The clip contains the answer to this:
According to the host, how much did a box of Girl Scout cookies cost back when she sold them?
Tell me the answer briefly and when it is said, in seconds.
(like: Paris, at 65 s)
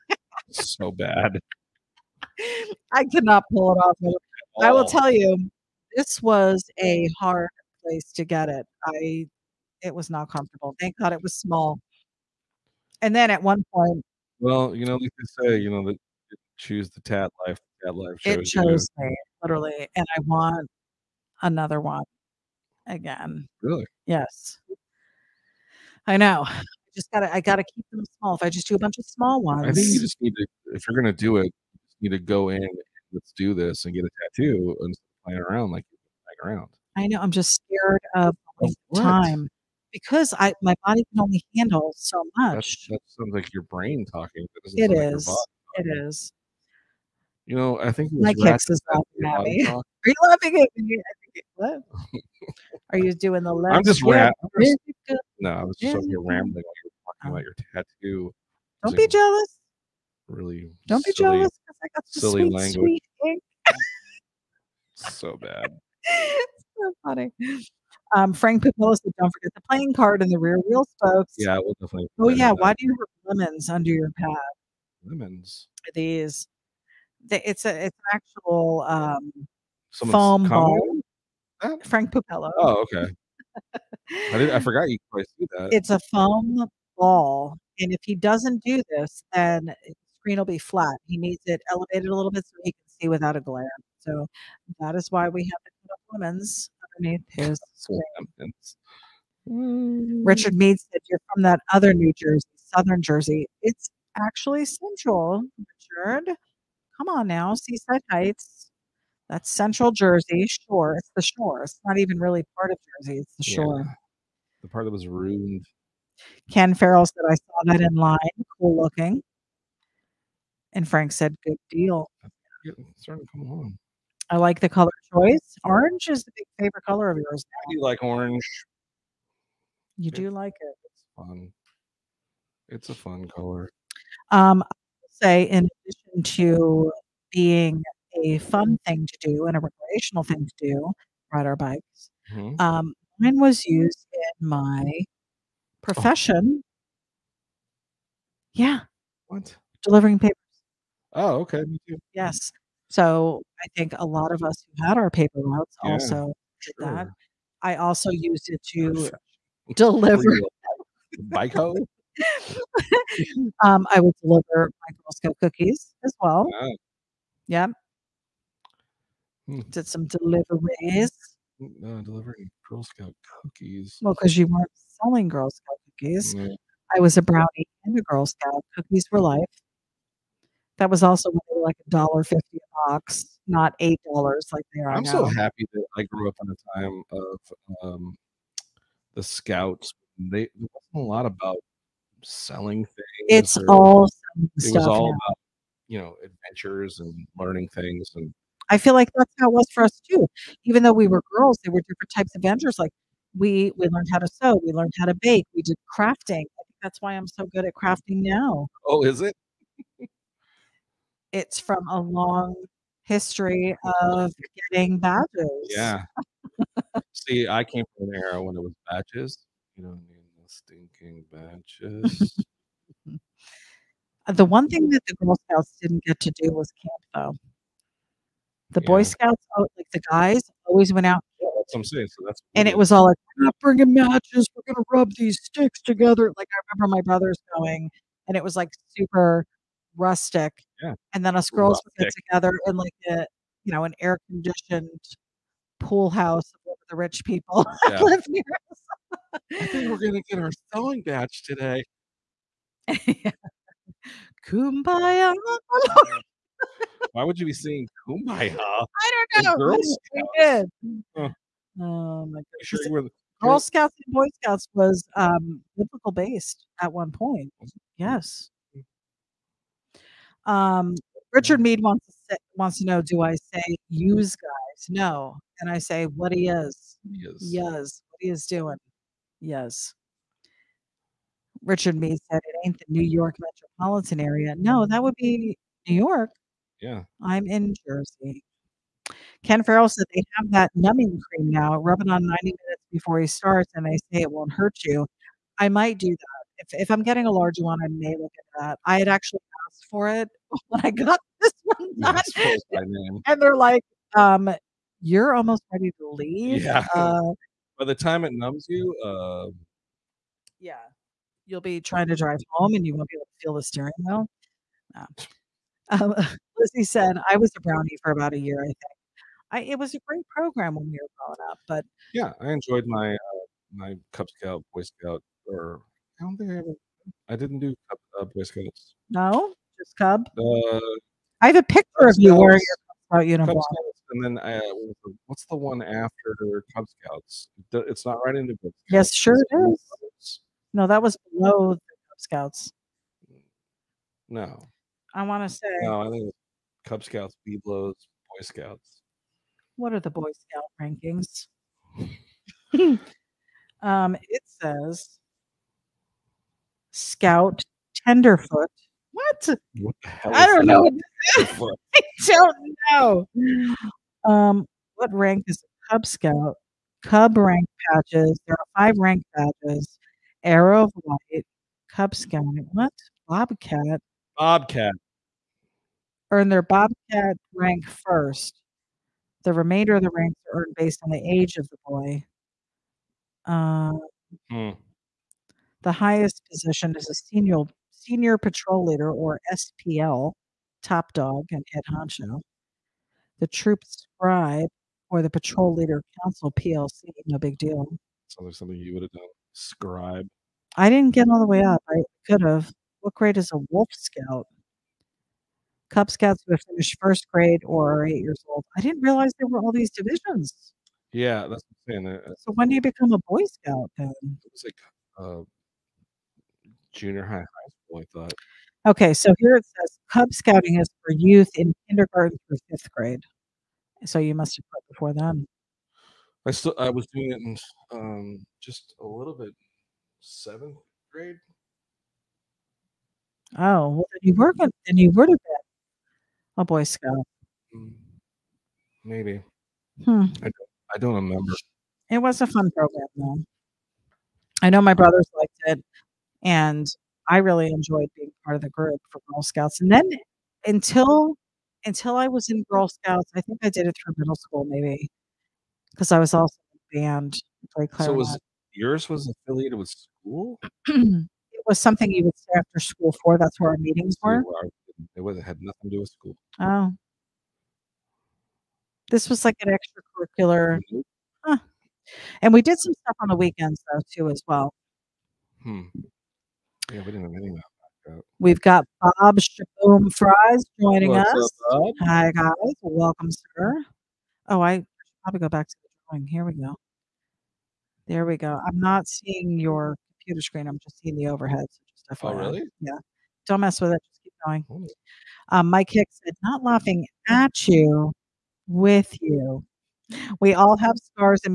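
$1.50, at 181 s.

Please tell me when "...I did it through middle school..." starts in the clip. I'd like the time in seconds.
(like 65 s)
453 s.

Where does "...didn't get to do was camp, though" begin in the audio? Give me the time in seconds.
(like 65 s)
225 s.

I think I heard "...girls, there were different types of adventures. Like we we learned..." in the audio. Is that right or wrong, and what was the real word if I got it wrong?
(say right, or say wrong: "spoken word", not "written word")
right.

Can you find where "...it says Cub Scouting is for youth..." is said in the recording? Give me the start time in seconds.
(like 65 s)
419 s.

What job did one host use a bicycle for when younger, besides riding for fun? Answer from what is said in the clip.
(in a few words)
Delivering papers.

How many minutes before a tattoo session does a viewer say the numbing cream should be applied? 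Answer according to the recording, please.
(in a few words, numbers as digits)
90.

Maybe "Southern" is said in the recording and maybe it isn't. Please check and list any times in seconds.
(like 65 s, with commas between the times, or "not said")
102 s.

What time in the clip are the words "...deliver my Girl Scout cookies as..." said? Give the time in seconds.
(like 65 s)
164 s.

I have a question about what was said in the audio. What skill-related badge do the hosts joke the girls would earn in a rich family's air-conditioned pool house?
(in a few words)
sewing badge.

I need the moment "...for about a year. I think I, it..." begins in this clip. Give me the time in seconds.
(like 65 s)
318 s.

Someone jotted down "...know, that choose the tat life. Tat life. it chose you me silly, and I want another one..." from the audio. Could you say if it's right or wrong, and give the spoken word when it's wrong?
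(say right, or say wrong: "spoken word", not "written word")
wrong: "literally", not "silly".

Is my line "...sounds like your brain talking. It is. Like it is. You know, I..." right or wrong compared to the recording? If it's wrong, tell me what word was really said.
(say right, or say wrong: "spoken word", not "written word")
right.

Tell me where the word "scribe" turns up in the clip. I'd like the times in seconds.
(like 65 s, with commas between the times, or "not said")
393 s, 399 s.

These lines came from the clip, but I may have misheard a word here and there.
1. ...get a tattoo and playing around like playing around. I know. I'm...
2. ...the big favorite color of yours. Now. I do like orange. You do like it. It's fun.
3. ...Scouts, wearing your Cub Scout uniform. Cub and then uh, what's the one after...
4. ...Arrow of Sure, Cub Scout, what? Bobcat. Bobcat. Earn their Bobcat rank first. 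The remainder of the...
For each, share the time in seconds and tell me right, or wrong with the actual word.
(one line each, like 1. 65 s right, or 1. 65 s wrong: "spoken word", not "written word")
1. 33 s right
2. 126 s right
3. 332 s right
4. 370 s wrong: "Light", not "Sure".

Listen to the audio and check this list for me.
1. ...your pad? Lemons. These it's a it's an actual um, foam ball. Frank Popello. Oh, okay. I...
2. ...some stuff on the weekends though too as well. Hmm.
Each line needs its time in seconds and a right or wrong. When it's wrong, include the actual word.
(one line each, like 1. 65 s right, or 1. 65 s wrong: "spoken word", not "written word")
1. 73 s right
2. 472 s right.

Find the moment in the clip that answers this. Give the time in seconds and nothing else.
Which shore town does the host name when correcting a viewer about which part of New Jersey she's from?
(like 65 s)
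107 s.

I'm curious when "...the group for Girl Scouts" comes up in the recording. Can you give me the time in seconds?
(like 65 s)
448 s.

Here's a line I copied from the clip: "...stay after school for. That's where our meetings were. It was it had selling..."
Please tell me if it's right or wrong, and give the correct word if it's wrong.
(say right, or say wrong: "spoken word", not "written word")
wrong: "nothing", not "selling".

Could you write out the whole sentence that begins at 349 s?
What are the Boy Scout rankings?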